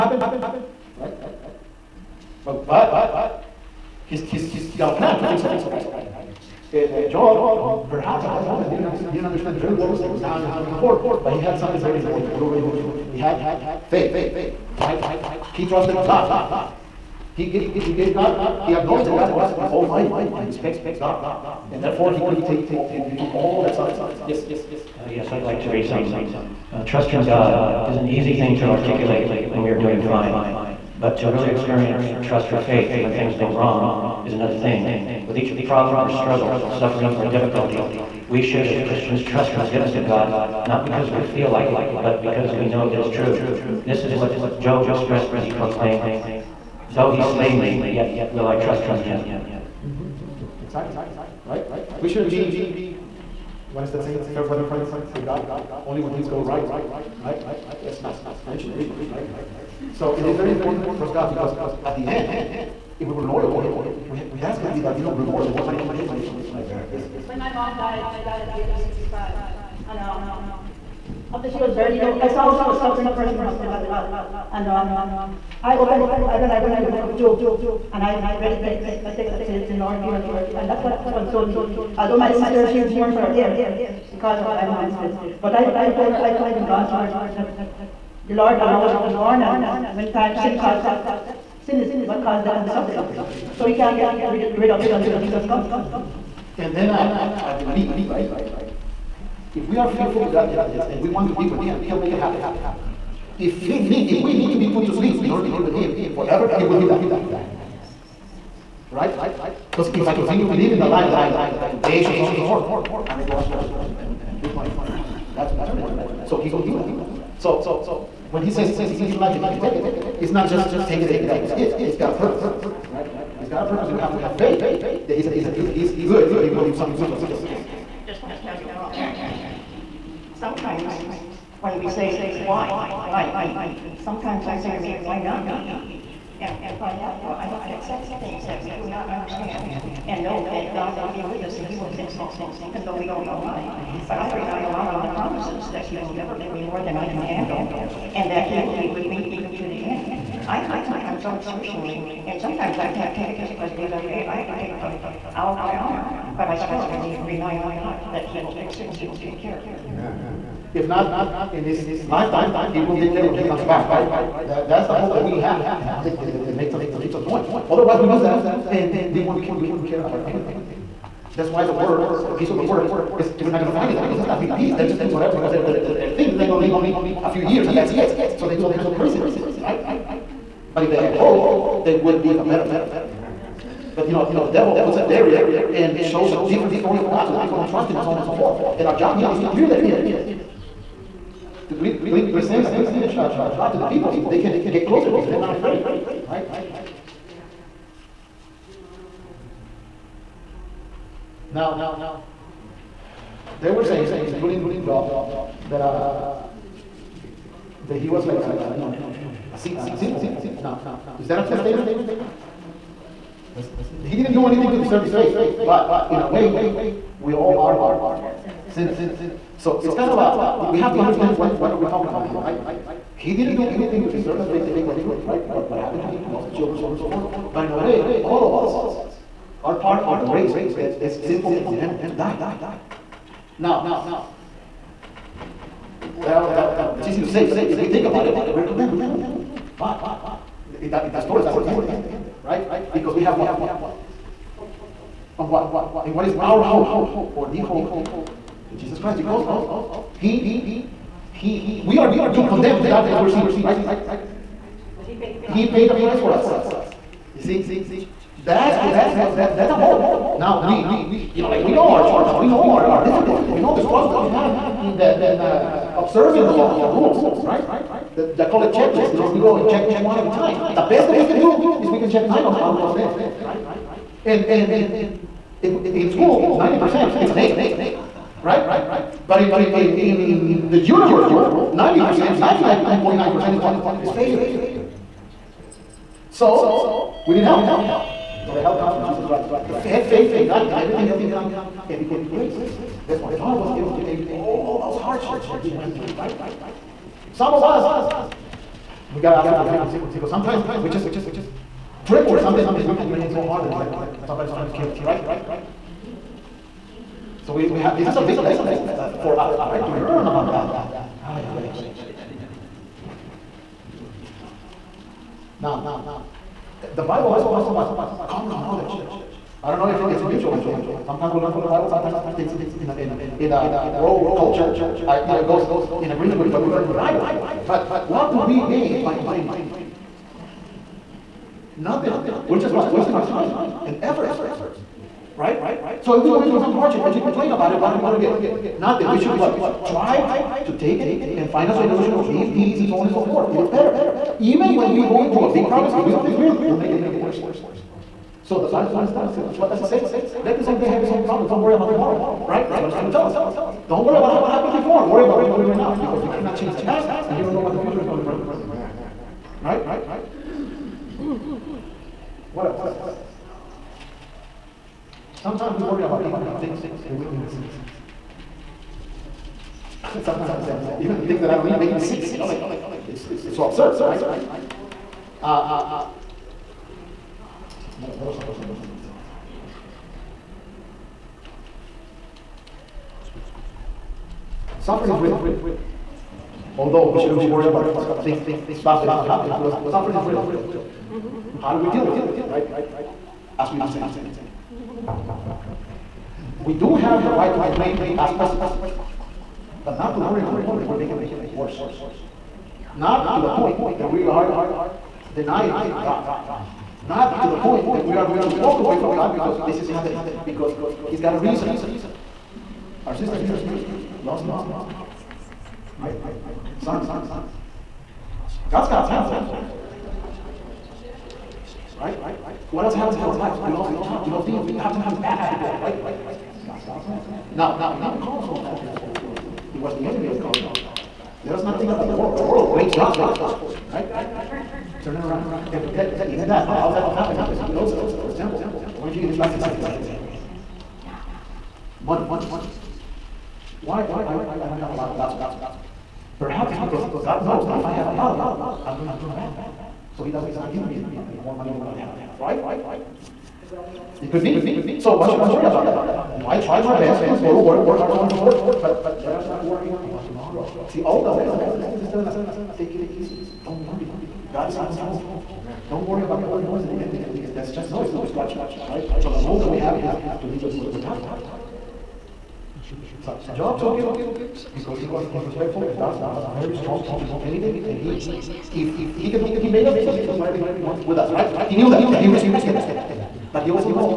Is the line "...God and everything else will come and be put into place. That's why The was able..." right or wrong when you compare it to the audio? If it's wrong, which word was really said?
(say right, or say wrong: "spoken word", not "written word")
wrong: "Job", not "The".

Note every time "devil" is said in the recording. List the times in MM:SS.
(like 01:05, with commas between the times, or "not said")
03:04.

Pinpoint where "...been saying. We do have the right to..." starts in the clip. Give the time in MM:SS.
06:33.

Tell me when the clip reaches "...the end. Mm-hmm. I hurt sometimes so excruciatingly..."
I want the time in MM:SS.
02:29.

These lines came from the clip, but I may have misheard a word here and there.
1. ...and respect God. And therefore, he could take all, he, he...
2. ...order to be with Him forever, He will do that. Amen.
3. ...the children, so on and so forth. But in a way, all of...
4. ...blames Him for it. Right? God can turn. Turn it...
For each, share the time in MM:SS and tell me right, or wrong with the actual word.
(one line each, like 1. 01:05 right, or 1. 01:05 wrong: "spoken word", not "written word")
1. 00:20 right
2. 01:45 right
3. 03:46 right
4. 07:12 wrong: "God", not "Him".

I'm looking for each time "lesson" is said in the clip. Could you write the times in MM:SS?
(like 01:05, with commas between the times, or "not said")
05:08, 07:41.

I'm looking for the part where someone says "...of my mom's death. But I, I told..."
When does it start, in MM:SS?
01:24.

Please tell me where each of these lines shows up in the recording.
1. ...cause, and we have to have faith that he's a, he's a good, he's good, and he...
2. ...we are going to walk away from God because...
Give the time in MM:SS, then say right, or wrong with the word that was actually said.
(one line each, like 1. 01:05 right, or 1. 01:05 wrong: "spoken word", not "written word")
1. 02:03 wrong: "purpose", not "cause"
2. 06:48 right.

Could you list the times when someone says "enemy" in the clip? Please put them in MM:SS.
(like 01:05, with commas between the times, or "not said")
07:10, 07:47.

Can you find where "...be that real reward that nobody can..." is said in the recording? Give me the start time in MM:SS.
01:04.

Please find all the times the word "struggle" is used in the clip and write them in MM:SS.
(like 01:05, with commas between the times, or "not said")
00:36, 04:23.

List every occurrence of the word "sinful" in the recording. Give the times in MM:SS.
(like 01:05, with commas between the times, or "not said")
03:29, 03:51.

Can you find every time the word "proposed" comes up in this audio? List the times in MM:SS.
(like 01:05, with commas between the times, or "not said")
not said.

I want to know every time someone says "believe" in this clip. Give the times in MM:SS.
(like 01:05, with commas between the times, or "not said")
01:37.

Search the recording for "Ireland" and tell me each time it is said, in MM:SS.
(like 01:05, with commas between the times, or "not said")
not said.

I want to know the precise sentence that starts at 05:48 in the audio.
So the Bible always tell us, what does it say?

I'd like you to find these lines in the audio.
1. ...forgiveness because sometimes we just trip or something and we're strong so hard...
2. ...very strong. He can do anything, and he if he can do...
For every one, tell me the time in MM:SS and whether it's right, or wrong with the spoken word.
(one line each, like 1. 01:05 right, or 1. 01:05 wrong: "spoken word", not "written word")
1. 04:59 wrong: "complaining", not "strong"
2. 07:56 right.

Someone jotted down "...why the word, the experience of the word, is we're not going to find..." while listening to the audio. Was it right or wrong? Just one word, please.
wrong.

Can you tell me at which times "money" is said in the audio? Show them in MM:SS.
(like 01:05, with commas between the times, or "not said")
07:22, 07:31.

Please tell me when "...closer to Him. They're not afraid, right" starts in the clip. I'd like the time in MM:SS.
03:14.